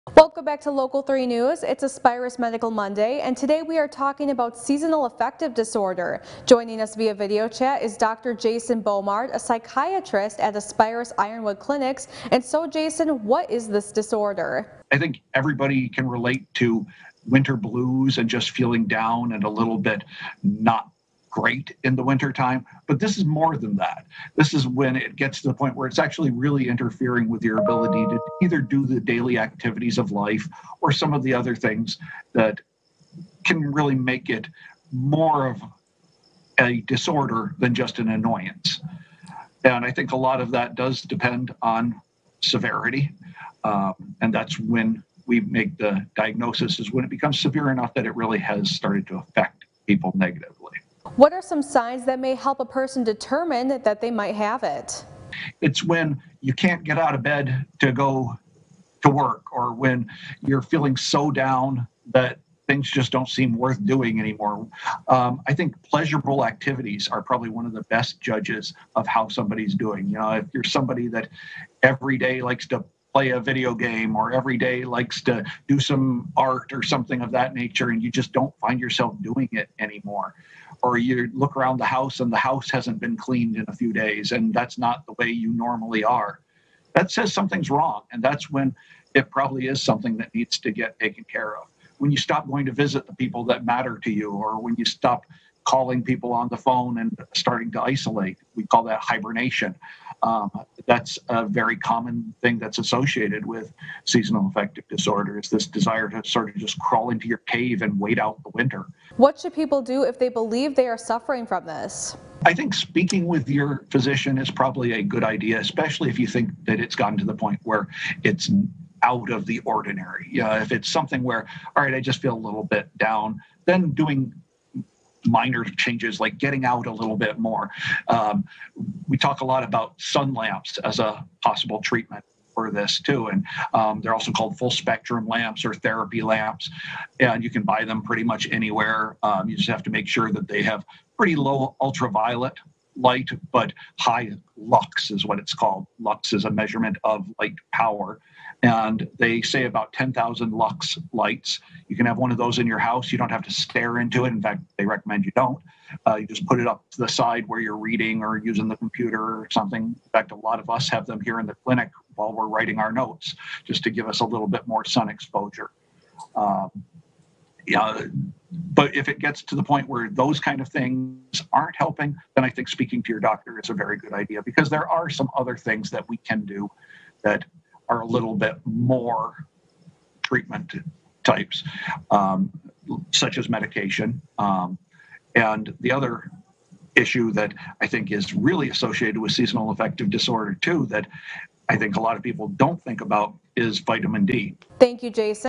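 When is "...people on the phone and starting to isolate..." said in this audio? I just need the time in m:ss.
1:36.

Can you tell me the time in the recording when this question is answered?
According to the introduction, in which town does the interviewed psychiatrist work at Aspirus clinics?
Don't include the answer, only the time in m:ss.
0:11.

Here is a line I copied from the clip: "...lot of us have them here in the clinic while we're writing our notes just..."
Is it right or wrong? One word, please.
right.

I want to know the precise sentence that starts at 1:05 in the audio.
Um, I think pleasurable activities are probably one of the best judges of how somebody's doing.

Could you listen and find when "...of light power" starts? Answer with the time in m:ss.
2:27.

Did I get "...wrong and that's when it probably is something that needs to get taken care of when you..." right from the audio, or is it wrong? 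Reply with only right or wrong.
right.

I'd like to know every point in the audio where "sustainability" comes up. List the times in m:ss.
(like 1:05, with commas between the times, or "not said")
not said.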